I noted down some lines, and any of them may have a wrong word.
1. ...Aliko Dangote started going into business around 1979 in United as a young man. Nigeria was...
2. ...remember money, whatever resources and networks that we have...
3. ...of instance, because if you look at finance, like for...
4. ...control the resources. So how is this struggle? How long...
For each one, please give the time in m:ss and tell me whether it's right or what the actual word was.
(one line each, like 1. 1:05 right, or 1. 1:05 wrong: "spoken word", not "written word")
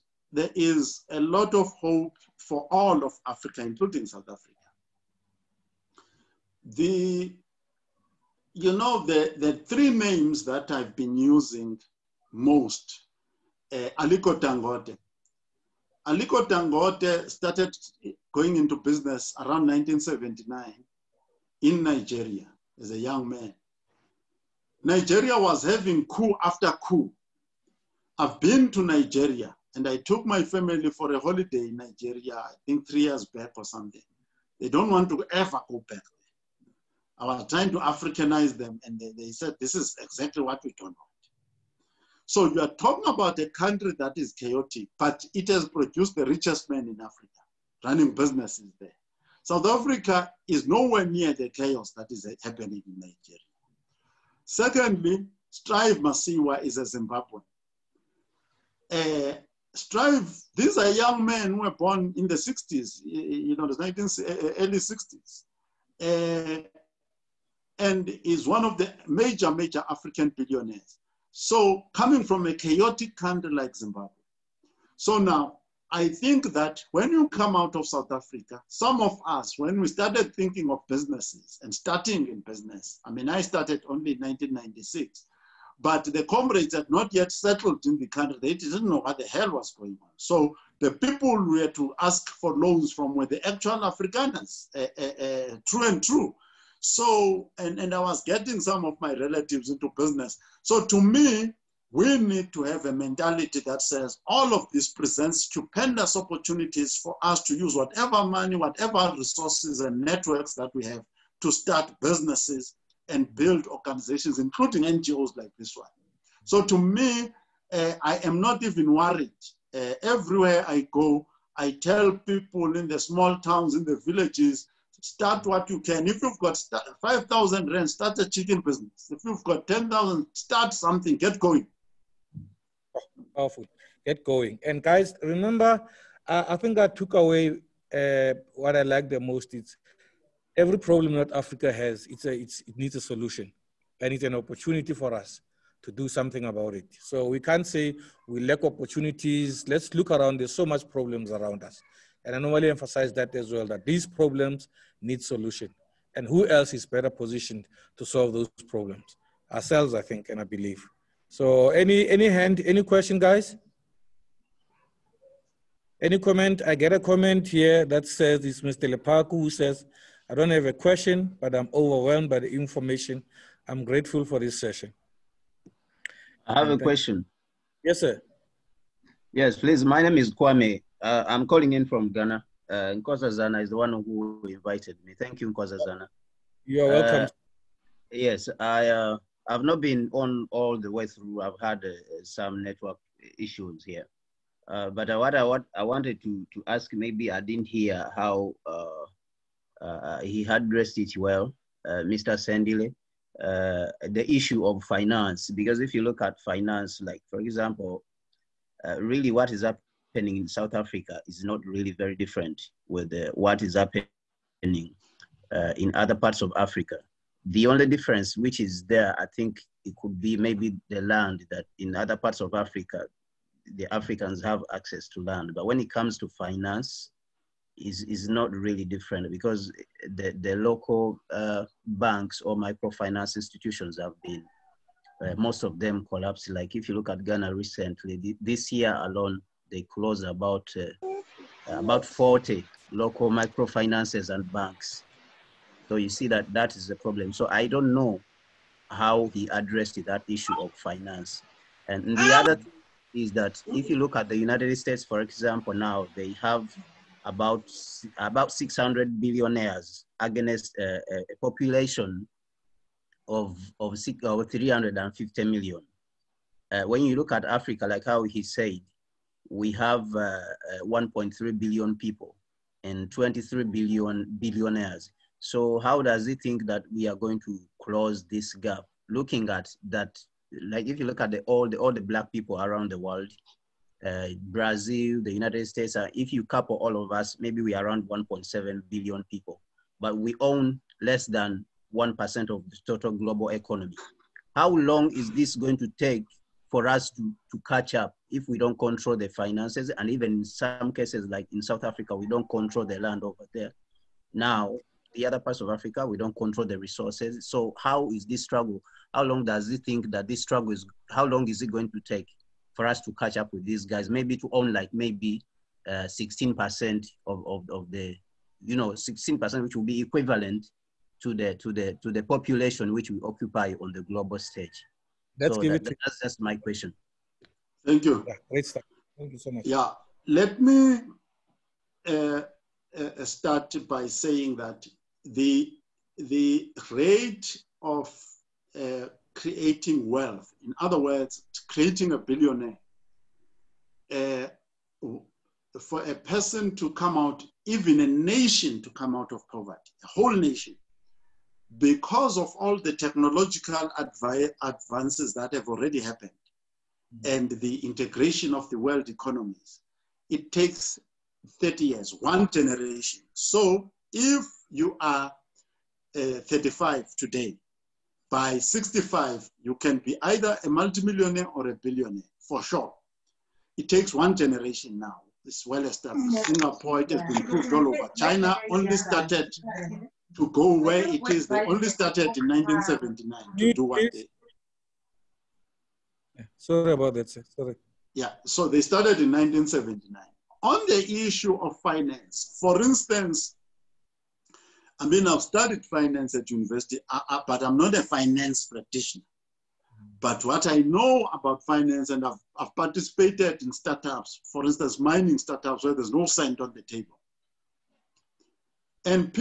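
1. 0:16 wrong: "Nigeria", not "United"
2. 1:47 wrong: "whatever", not "remember"
3. 3:24 wrong: "finance", not "instance"
4. 5:06 right.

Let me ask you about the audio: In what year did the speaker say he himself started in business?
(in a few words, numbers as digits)
1996.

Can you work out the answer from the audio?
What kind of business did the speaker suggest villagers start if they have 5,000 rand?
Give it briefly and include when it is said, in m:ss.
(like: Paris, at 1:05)
chicken business, at 2:08.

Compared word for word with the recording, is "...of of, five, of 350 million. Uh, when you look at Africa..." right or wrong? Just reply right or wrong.
wrong.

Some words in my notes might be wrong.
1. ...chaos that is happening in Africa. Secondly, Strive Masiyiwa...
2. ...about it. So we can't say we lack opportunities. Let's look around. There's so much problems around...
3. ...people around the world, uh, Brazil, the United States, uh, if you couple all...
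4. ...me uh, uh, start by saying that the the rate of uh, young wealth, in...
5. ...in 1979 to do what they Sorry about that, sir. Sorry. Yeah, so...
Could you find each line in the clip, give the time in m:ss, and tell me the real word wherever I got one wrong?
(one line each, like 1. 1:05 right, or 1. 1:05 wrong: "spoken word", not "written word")
1. 0:51 wrong: "Nigeria", not "Africa"
2. 2:26 right
3. 4:42 right
4. 5:30 wrong: "creating", not "young"
5. 6:22 right.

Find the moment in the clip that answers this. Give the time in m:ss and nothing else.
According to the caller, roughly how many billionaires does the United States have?
4:18.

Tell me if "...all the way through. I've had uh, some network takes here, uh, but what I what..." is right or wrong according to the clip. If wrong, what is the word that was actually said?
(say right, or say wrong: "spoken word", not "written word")
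wrong: "issues", not "takes".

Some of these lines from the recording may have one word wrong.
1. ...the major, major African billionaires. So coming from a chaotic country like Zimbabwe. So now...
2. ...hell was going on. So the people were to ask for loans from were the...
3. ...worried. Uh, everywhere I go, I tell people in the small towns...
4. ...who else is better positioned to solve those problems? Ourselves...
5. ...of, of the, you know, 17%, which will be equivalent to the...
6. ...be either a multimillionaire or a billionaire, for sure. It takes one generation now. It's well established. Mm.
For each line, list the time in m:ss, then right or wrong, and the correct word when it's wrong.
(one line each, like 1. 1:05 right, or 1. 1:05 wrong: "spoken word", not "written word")
1. 1:08 right
2. 1:29 right
3. 1:58 right
4. 2:36 right
5. 5:17 wrong: "16", not "17"
6. 6:09 right.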